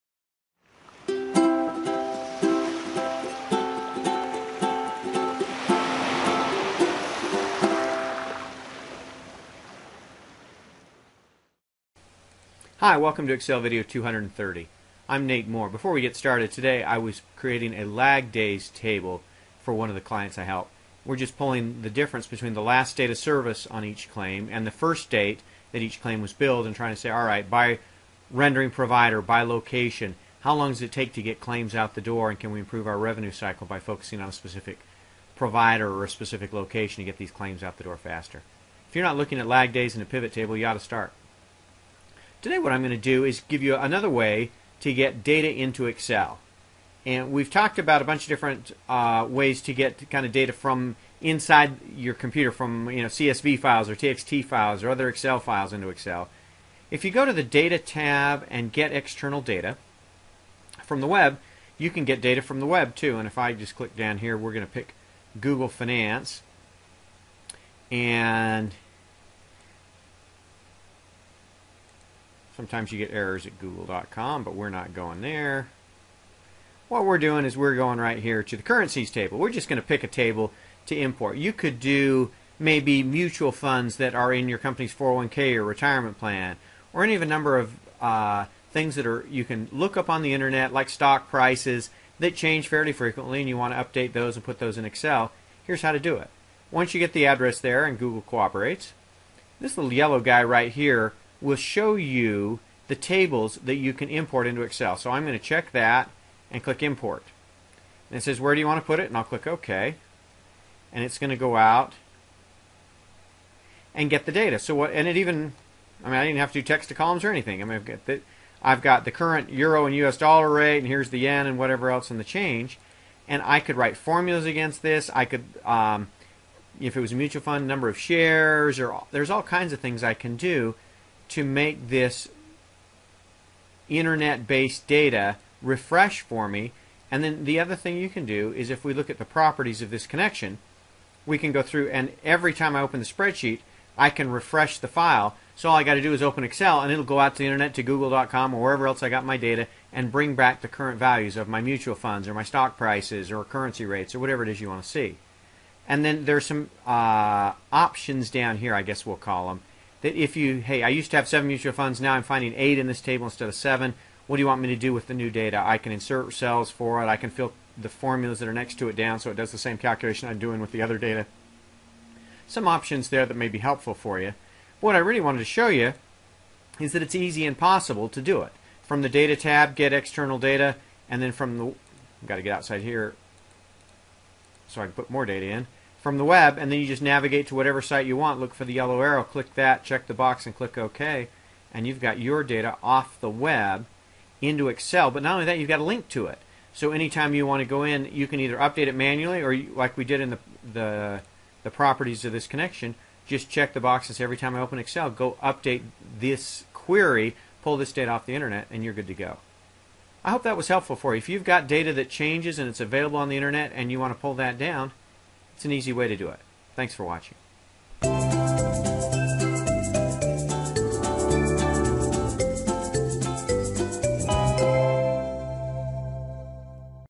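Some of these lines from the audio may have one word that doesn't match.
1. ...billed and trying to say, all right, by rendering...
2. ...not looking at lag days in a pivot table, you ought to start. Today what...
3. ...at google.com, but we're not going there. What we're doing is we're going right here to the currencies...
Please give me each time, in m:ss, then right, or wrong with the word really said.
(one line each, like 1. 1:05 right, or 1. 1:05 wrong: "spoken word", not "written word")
1. 0:26 right
2. 0:39 right
3. 1:13 right.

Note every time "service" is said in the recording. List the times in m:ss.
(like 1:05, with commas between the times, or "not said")
0:23.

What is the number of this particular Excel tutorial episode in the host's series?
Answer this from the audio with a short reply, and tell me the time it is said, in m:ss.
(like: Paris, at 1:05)
230, at 0:13.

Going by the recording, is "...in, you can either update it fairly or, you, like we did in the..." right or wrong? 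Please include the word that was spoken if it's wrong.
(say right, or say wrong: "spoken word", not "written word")
wrong: "manually", not "fairly".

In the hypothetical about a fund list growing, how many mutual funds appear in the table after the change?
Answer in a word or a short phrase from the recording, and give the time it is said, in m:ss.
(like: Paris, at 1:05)
8, at 2:42.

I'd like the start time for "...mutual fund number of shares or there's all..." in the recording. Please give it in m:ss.
2:07.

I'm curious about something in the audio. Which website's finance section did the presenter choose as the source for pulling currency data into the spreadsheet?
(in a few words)
Google Finance.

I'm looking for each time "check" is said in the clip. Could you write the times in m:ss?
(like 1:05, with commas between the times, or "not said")
1:45, 3:09, 3:23.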